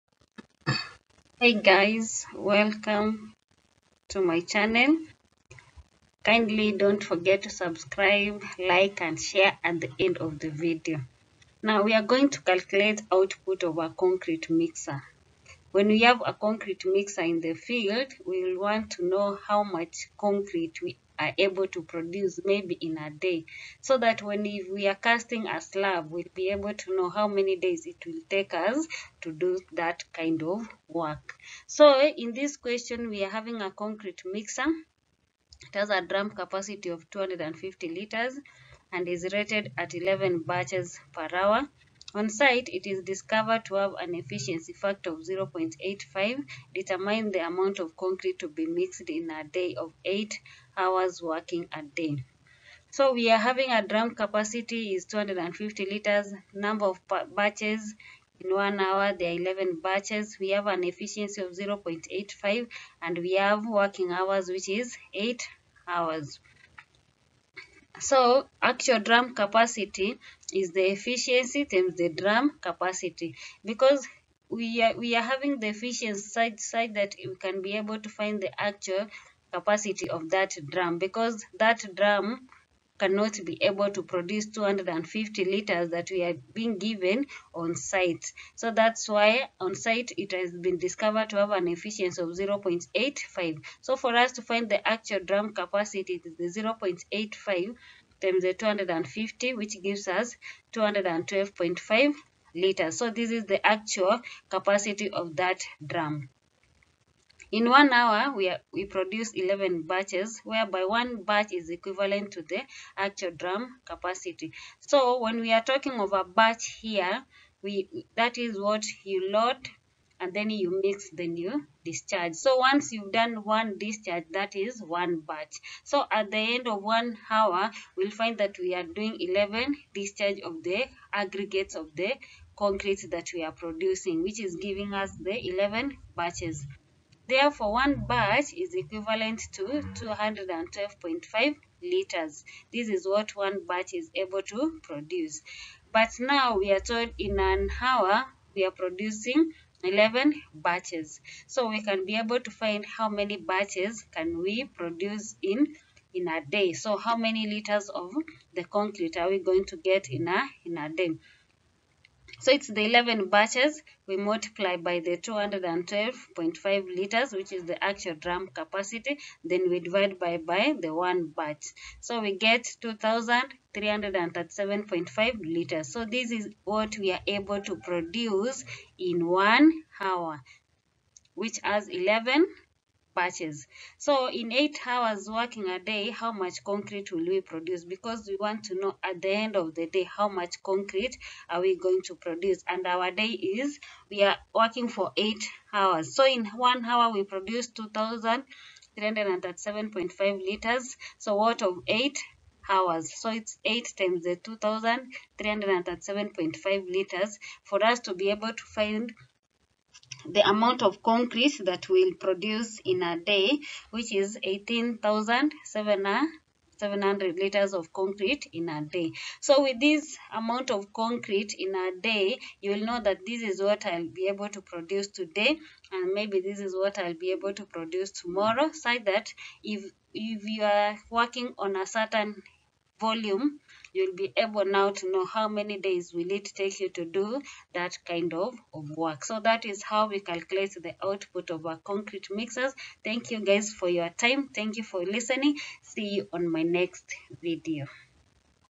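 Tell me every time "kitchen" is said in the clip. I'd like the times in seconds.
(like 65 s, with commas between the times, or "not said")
not said.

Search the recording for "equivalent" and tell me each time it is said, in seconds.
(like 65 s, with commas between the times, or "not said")
111 s, 138 s.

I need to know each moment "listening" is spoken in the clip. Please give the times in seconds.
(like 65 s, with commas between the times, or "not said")
245 s.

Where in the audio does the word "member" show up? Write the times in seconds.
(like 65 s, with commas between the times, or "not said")
not said.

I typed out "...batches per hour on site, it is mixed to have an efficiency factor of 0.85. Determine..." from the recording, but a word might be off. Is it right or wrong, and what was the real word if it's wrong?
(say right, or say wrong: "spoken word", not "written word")
wrong: "discovered", not "mixed".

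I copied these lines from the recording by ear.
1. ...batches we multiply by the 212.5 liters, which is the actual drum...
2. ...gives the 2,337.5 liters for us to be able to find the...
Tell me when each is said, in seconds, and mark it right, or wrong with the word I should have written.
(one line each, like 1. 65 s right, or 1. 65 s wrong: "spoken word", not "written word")
1. 163 s right
2. 203 s wrong: "times", not "gives".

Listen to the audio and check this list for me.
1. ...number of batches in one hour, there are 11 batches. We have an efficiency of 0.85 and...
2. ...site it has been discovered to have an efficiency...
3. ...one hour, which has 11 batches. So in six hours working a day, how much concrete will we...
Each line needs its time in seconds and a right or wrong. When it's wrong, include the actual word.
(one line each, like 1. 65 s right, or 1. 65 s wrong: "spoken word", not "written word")
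1. 56 s right
2. 89 s right
3. 179 s wrong: "eight", not "six".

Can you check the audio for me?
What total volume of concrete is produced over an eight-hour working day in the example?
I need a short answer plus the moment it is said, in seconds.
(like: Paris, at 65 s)
18,700 liters, at 214 s.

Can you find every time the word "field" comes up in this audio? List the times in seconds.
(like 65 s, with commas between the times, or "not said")
17 s.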